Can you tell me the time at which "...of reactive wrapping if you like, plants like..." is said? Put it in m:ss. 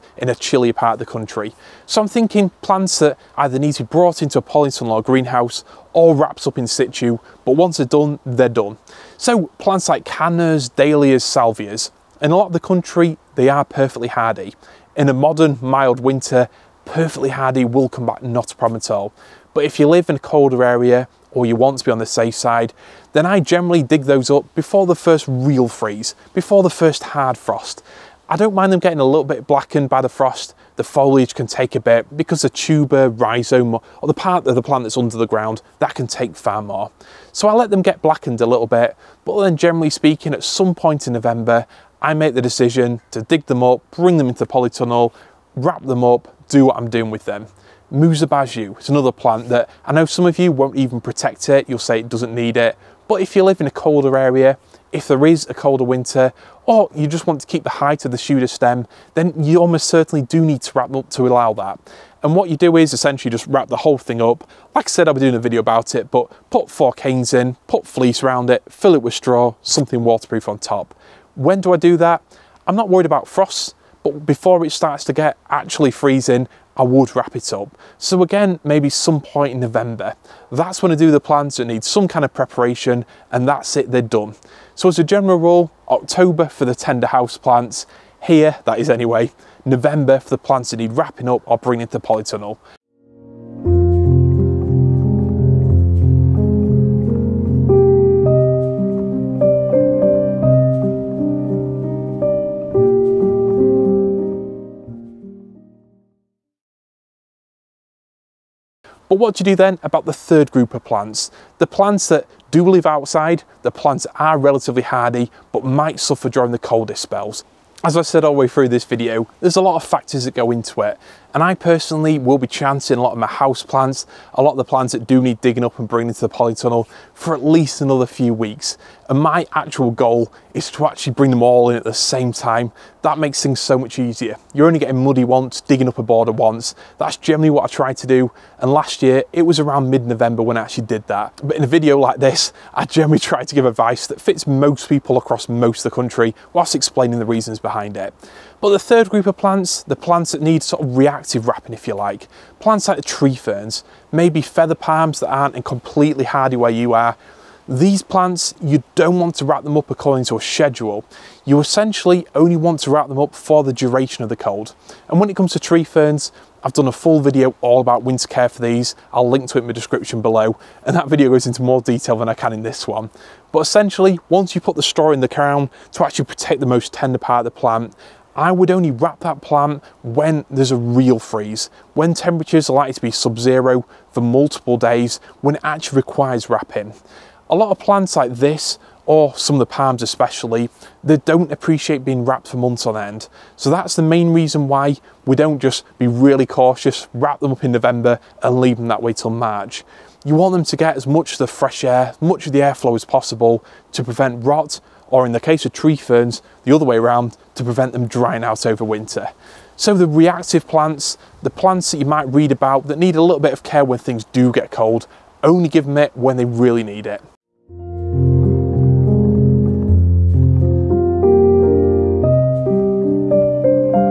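2:30.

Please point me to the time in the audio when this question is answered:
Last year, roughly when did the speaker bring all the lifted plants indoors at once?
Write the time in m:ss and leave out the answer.
2:19.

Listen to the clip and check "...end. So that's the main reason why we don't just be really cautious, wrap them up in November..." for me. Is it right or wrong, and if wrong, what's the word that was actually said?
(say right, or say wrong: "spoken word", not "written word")
right.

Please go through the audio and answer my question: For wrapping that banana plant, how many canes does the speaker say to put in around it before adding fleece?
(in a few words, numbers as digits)
4.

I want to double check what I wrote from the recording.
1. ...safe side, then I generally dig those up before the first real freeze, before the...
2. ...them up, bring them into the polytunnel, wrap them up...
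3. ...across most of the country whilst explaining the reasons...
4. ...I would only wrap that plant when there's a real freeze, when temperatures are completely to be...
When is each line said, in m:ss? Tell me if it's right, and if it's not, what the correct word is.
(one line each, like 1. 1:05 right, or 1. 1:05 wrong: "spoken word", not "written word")
1. 0:22 right
2. 0:43 right
3. 2:25 right
4. 2:58 wrong: "likely", not "completely".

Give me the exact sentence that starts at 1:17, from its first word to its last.
So again, maybe some point in November.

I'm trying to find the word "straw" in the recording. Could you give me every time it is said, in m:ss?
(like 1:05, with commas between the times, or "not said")
1:09, 2:54.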